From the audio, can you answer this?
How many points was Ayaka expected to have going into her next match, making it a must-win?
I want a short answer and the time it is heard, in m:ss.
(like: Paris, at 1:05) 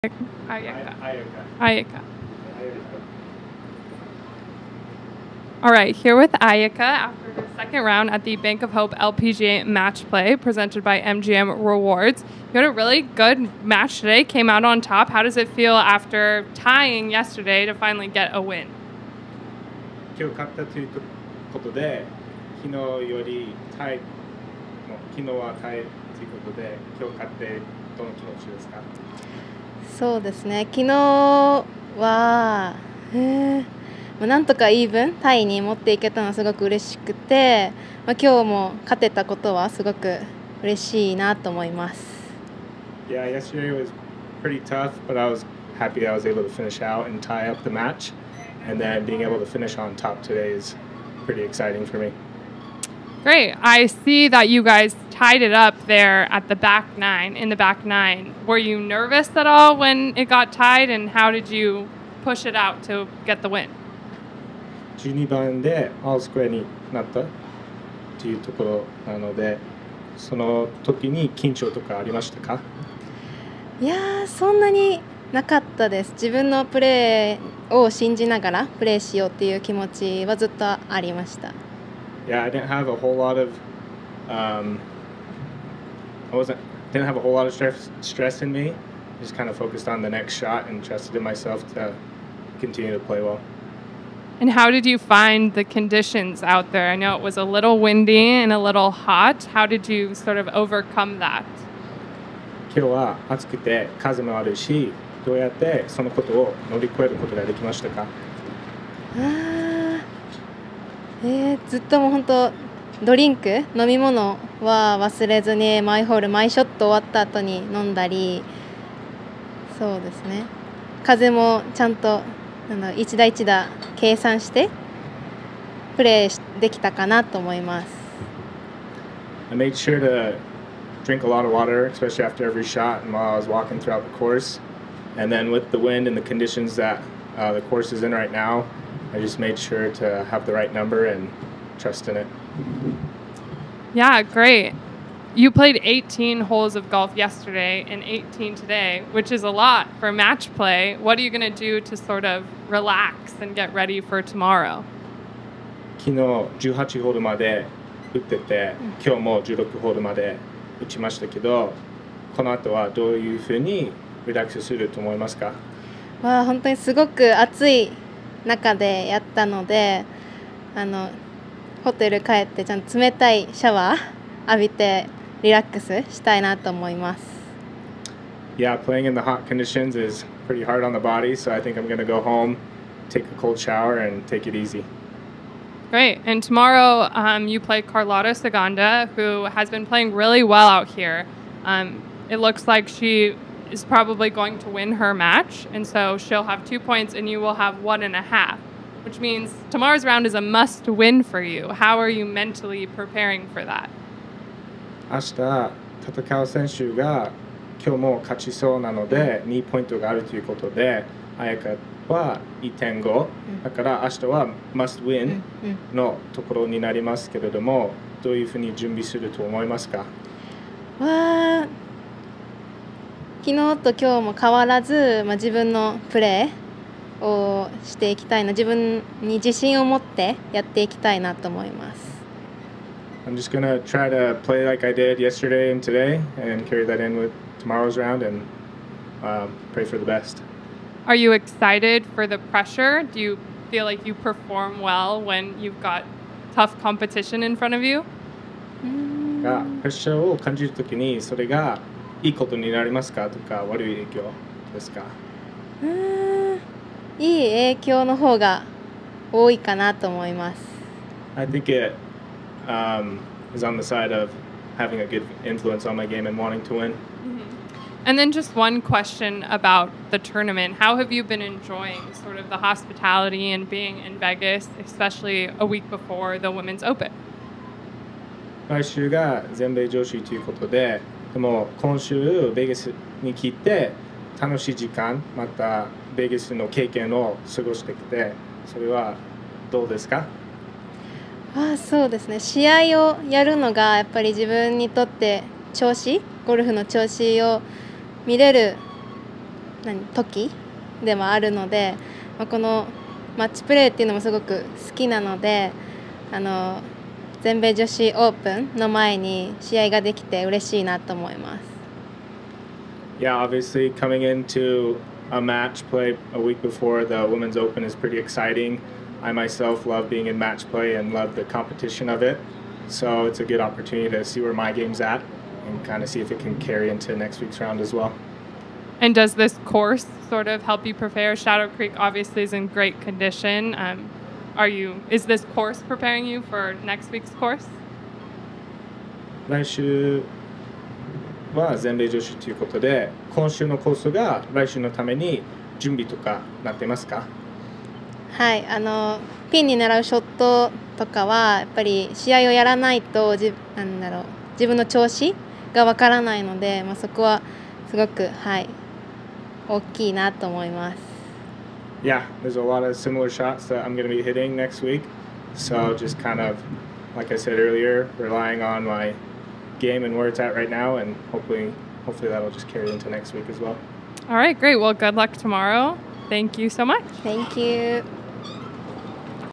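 1.5, at 3:17.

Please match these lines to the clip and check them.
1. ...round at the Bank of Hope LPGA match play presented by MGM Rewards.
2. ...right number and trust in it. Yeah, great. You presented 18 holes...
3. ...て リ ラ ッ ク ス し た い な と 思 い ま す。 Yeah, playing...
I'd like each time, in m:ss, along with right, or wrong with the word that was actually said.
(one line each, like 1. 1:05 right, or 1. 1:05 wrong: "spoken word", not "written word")
1. 0:07 right
2. 2:20 wrong: "played", not "presented"
3. 2:54 right.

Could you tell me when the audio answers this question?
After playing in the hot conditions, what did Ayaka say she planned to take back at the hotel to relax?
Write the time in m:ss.
3:03.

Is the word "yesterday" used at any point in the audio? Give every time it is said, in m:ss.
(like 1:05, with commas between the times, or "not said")
0:17, 0:43, 2:27, 3:55.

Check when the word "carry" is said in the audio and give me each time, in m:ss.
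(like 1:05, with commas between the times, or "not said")
3:56, 5:26, 6:12.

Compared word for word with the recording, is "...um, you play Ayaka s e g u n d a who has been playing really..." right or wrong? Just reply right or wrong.
wrong.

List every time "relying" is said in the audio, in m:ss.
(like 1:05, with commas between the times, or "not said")
6:08.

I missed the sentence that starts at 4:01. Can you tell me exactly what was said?
Are you excited for the pressure?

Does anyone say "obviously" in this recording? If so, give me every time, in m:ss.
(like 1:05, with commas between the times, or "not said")
5:13, 5:31.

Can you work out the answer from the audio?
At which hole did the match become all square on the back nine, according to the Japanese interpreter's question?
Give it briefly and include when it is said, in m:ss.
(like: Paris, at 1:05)
12, at 1:04.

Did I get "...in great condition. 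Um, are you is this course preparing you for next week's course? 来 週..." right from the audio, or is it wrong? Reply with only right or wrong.
right.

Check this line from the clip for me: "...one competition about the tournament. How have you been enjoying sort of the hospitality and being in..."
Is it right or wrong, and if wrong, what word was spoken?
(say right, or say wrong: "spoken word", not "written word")
wrong: "question", not "competition".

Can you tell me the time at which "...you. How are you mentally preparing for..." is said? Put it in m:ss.
3:21.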